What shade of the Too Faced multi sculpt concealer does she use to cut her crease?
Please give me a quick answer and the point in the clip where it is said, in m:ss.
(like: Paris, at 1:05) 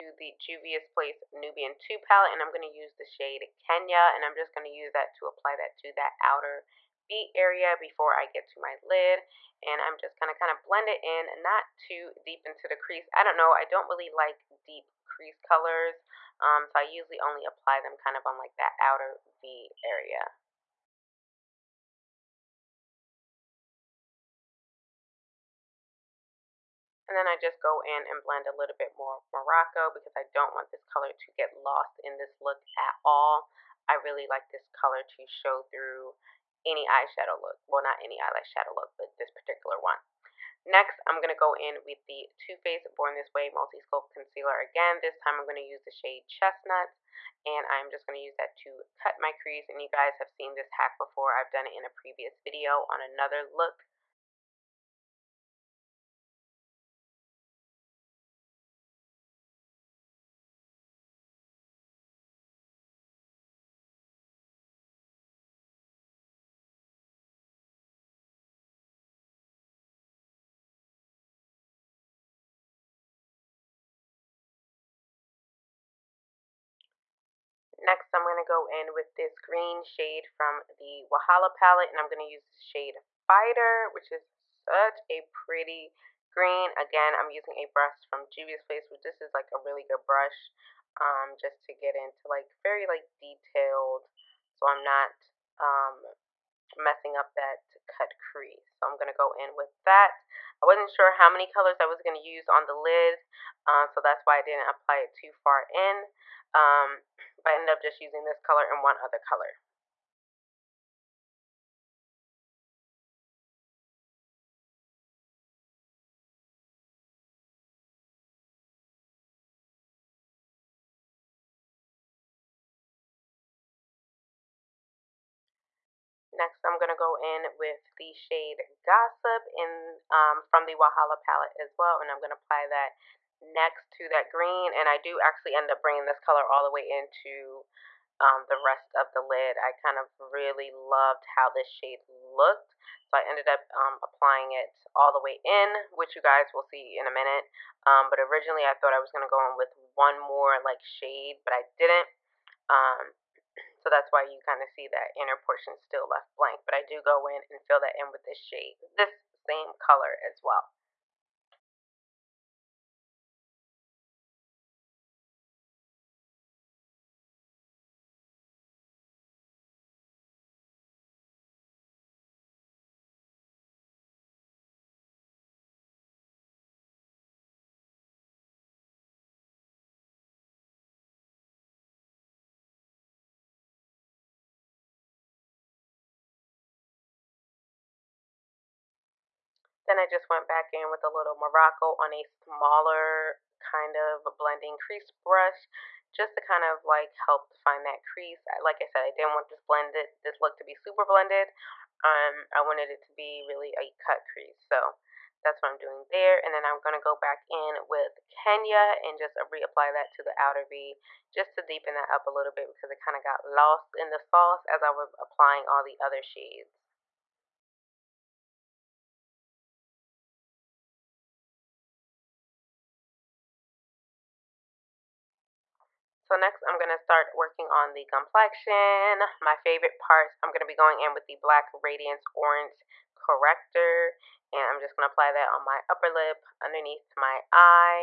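Chestnut, at 0:46.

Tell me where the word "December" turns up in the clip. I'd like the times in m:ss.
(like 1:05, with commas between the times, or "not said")
not said.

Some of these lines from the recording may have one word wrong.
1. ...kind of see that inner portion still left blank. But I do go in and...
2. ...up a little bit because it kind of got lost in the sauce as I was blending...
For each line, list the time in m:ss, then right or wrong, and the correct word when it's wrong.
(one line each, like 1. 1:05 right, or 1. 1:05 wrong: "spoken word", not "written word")
1. 2:34 right
2. 3:32 wrong: "applying", not "blending".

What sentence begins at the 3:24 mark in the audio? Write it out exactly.
So that's what I'm doing there.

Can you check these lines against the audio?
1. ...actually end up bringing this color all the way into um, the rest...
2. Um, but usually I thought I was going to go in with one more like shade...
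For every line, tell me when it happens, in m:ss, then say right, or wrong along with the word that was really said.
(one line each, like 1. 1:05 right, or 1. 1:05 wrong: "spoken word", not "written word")
1. 2:15 right
2. 2:27 wrong: "originally", not "usually".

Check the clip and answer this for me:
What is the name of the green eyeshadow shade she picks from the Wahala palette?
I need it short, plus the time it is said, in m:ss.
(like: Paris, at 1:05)
Fighter, at 1:23.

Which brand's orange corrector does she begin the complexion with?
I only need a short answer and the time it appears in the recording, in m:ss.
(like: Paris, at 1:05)
Black Radiance, at 3:51.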